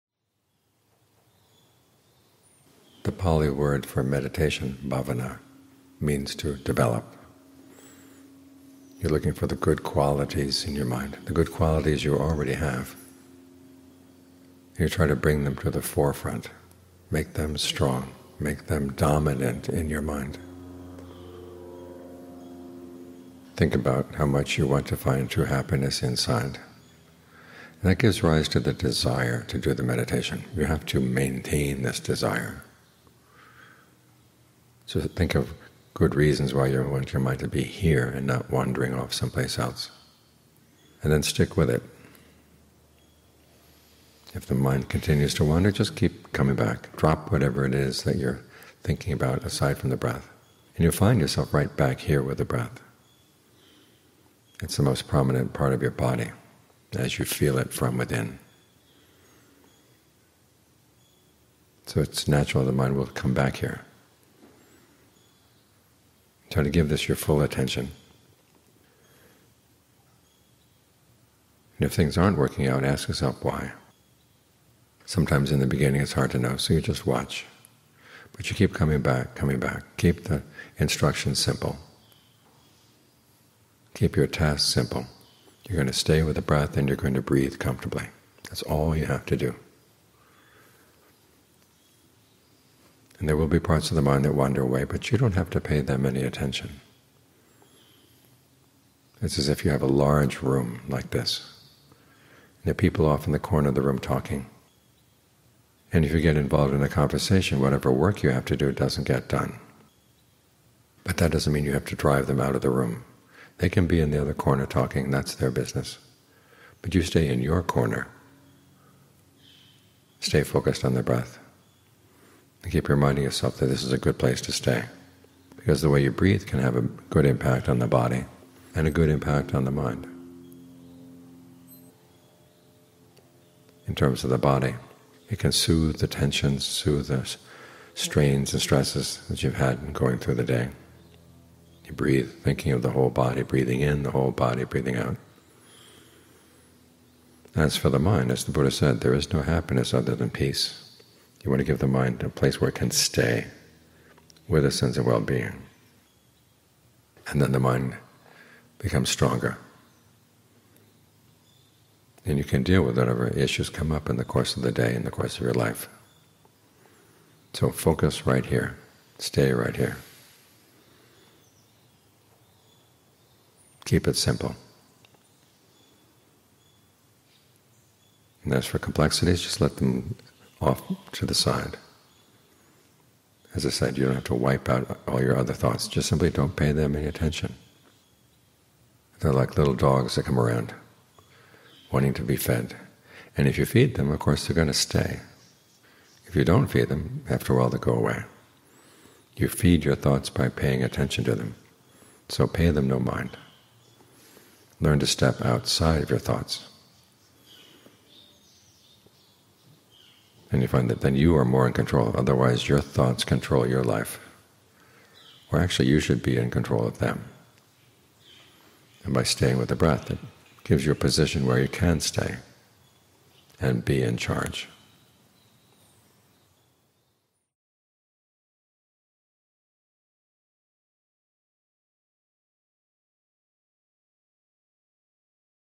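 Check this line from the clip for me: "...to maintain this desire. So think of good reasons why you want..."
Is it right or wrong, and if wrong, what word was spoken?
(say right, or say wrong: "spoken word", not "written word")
right.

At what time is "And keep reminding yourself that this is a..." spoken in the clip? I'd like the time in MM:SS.
02:02.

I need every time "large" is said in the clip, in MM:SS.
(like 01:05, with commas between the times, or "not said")
01:39.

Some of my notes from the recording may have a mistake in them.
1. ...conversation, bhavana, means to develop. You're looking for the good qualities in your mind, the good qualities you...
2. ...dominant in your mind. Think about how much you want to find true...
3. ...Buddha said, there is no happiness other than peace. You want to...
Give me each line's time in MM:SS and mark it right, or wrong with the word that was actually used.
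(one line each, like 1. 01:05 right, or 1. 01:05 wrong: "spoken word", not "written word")
1. 00:04 wrong: "meditation", not "conversation"
2. 00:18 right
3. 02:28 right.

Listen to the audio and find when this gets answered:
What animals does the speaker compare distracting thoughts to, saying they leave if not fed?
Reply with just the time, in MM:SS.
03:09.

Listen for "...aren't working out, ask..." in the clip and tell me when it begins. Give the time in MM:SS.
01:12.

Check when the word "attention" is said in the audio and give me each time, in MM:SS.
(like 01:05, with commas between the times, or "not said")
01:07, 01:36, 03:07, 03:20.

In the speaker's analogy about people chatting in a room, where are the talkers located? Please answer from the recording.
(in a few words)
in the corner of the room.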